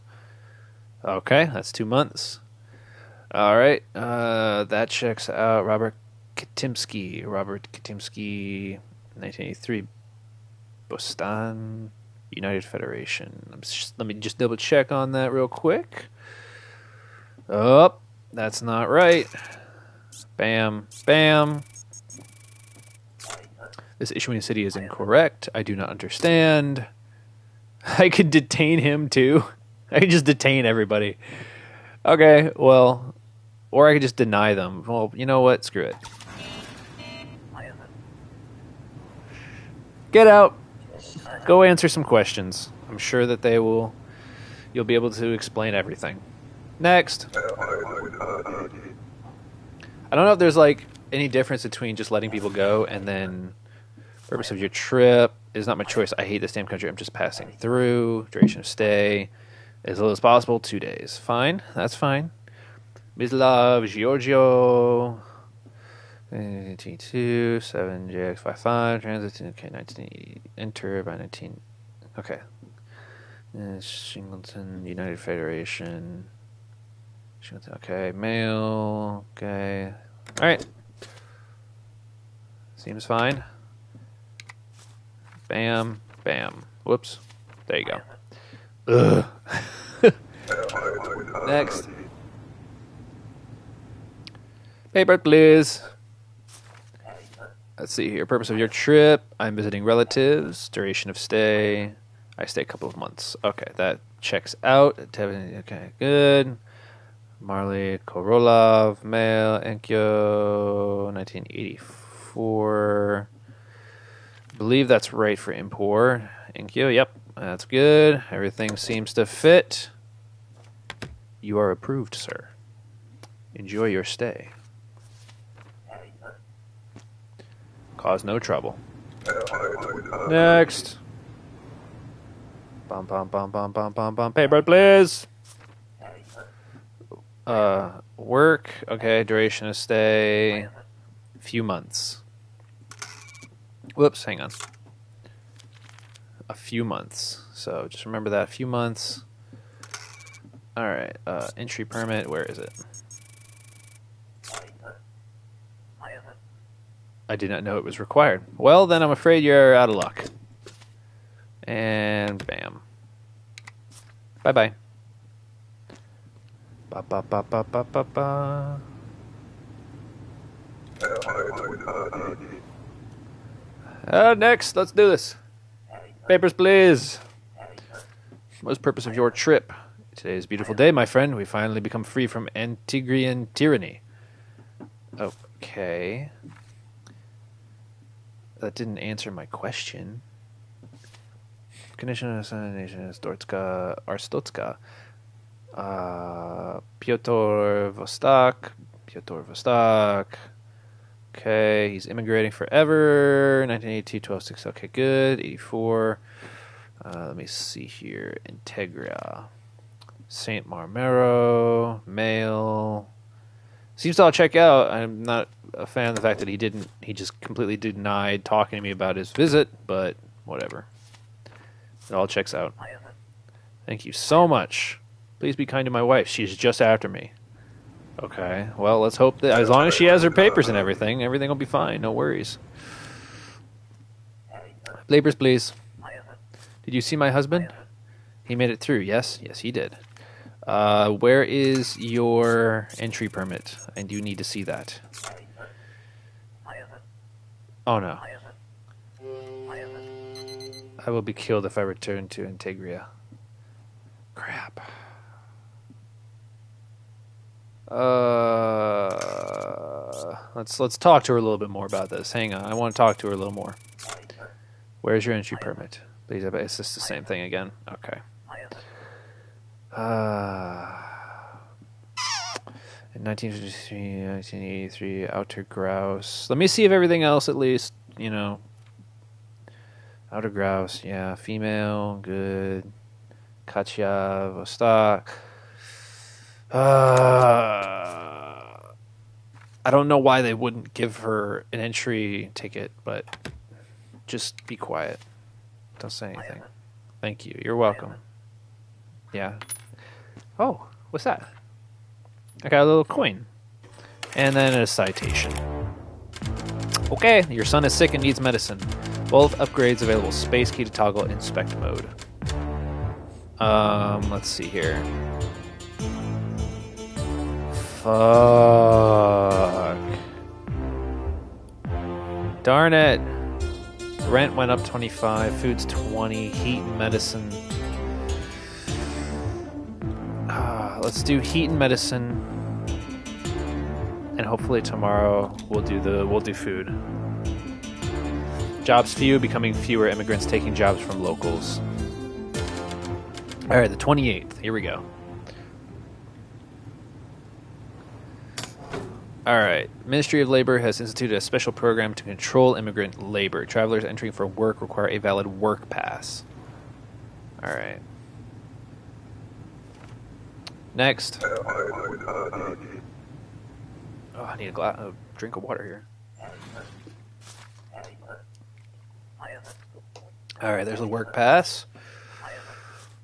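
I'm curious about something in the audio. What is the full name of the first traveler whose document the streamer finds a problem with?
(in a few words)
Robert Katimsky.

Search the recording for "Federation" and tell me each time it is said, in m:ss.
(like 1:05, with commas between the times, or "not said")
0:12, 1:15.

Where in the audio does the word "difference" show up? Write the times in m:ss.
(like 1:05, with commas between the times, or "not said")
0:51.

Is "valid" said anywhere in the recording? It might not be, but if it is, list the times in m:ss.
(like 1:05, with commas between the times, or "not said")
5:55.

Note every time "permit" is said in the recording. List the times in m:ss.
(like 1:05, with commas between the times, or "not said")
2:31, 4:03, 4:25.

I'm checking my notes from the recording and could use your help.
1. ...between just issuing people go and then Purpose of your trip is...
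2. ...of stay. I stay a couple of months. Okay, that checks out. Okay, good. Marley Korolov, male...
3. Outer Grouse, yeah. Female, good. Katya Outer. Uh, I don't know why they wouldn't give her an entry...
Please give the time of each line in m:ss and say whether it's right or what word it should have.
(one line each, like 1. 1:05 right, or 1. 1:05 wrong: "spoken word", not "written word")
1. 0:51 wrong: "letting", not "issuing"
2. 1:41 right
3. 4:40 wrong: "Vostok", not "Outer".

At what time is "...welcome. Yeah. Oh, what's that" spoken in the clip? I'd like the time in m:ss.
4:57.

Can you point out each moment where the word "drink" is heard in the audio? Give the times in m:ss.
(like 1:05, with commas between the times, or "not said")
6:05.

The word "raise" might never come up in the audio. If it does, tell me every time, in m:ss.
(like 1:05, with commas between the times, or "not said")
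not said.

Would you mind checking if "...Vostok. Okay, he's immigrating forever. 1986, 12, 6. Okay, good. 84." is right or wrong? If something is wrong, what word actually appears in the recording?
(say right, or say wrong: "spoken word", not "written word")
wrong: "1982", not "1986".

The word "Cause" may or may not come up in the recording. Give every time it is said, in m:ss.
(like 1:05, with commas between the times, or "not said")
2:07.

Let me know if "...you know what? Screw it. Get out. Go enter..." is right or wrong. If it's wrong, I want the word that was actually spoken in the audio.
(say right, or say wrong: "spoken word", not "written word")
wrong: "answer", not "enter".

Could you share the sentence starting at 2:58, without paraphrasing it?
What is the purpose of your trip?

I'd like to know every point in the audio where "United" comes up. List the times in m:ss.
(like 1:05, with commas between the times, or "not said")
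0:12, 1:14.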